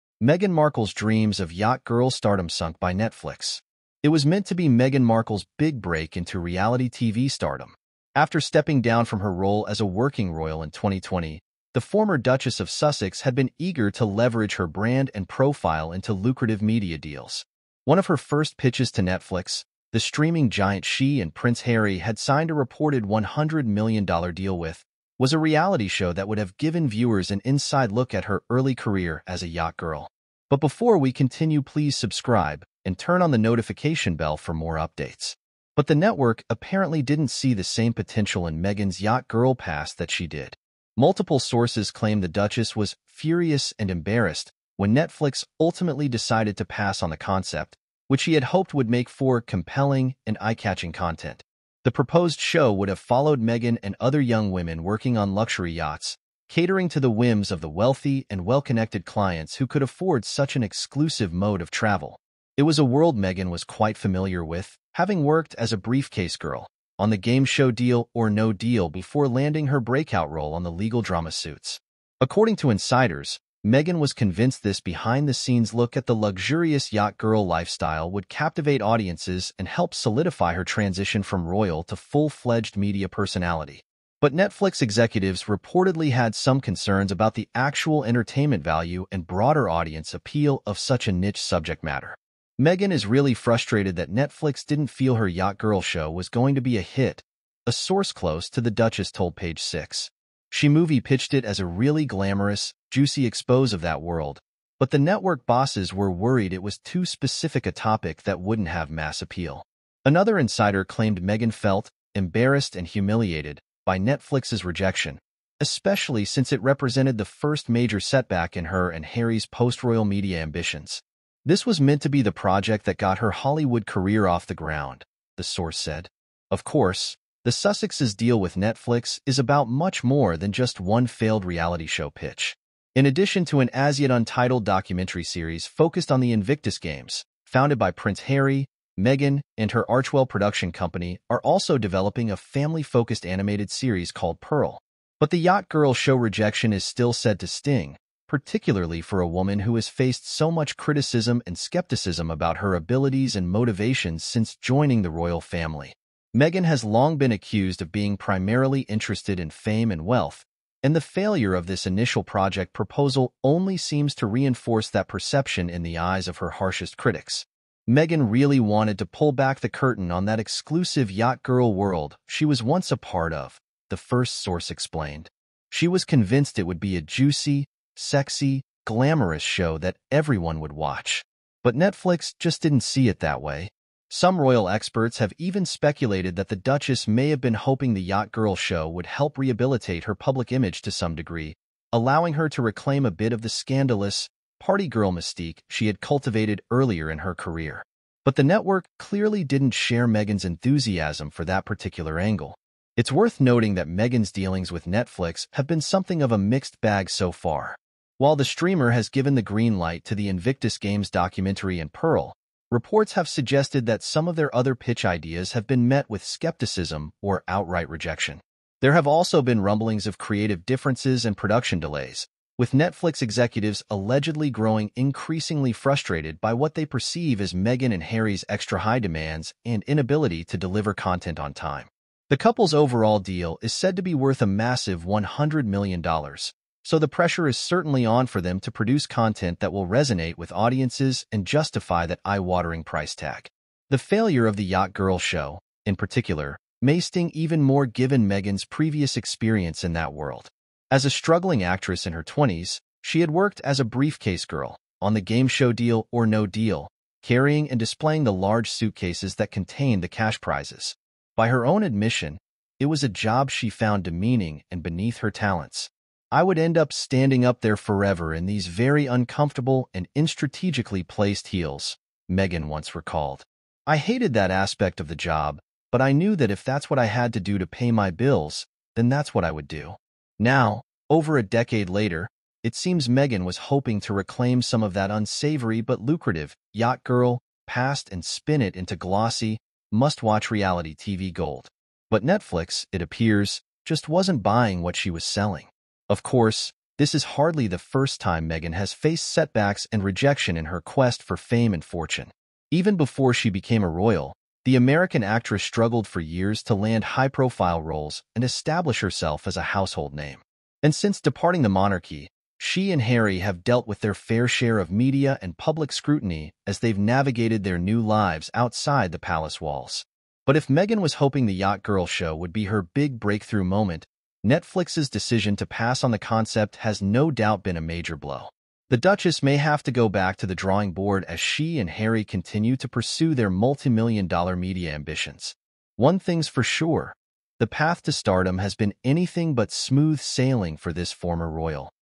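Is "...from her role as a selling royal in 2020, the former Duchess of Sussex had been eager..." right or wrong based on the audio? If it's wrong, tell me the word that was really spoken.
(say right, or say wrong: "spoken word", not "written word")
wrong: "working", not "selling".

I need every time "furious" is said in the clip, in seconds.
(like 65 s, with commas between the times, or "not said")
43 s.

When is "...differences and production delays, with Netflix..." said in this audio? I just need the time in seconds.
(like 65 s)
220 s.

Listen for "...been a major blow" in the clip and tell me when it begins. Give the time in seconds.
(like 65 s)
327 s.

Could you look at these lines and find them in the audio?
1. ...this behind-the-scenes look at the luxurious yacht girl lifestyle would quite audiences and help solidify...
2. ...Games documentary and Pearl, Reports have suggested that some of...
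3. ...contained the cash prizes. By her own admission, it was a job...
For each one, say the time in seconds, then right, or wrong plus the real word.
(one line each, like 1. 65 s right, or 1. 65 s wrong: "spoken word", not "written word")
1. 74 s wrong: "captivate", not "quite"
2. 210 s right
3. 259 s right.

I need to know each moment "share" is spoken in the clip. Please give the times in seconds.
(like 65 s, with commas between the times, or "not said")
199 s, 314 s.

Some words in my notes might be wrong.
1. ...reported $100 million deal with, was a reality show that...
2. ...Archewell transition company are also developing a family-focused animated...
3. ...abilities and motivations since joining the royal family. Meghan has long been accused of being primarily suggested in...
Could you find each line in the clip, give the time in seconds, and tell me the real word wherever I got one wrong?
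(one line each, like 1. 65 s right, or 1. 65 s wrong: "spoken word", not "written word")
1. 22 s right
2. 139 s wrong: "production", not "transition"
3. 152 s wrong: "interested", not "suggested".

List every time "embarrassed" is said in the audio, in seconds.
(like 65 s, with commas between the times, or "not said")
43 s, 112 s.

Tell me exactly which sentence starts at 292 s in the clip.
But Netflix, it appears, just wasn't buying what she was selling.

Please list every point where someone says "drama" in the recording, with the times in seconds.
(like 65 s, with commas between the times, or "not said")
71 s.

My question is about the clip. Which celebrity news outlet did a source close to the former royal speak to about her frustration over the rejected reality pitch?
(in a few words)
Page 6.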